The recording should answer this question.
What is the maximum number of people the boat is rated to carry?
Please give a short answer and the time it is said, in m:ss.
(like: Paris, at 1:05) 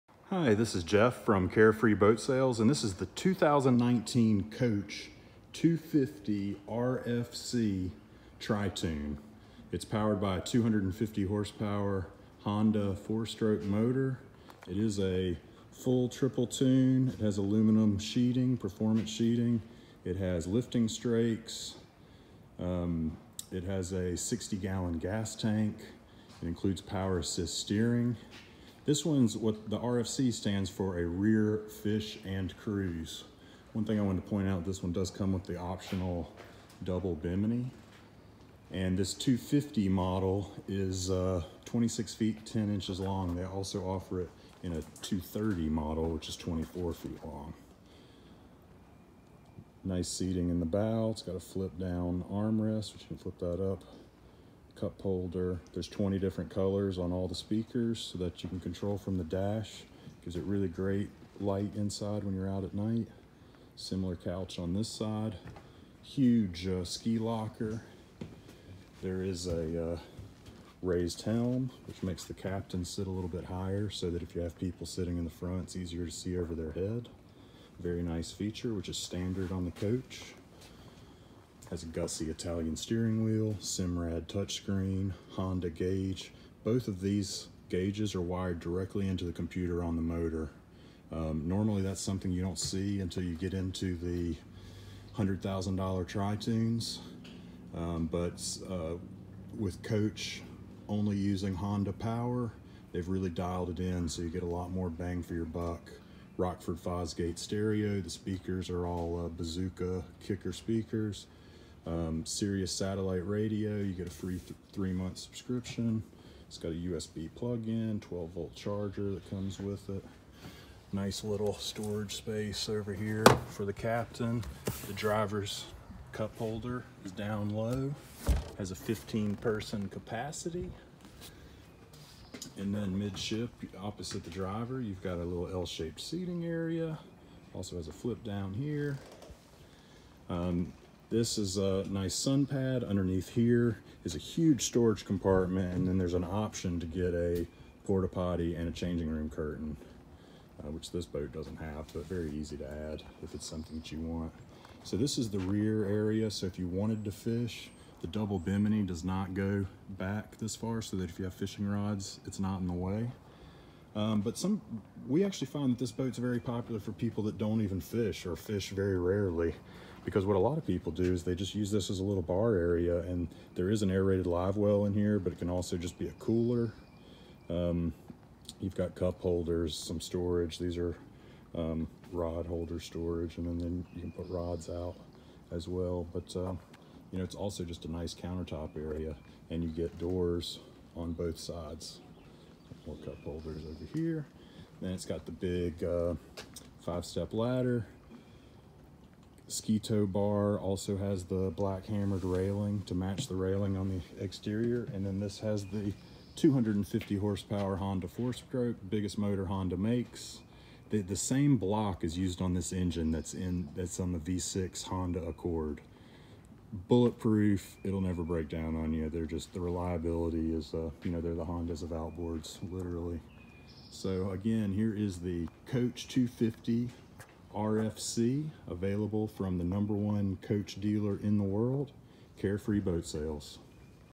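15, at 2:08.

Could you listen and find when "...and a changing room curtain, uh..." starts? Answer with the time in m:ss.
2:28.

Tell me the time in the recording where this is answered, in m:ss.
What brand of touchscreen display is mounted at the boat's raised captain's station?
1:23.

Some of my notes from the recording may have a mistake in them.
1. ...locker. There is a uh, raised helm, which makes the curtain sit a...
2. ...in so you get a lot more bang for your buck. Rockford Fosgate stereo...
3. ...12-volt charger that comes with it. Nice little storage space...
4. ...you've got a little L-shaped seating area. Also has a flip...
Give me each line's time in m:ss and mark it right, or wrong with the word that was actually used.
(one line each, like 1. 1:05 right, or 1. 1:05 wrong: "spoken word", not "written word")
1. 1:07 wrong: "captain", not "curtain"
2. 1:43 right
3. 1:58 right
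4. 2:14 right.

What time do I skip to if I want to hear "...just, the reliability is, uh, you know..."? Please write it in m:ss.
3:39.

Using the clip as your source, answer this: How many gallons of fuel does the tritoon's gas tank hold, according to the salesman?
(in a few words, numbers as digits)
60.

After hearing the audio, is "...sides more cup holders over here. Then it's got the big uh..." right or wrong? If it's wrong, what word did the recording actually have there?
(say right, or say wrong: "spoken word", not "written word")
right.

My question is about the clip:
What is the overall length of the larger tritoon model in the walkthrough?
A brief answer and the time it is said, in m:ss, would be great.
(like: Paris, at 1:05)
26 feet, 10 inches, at 0:41.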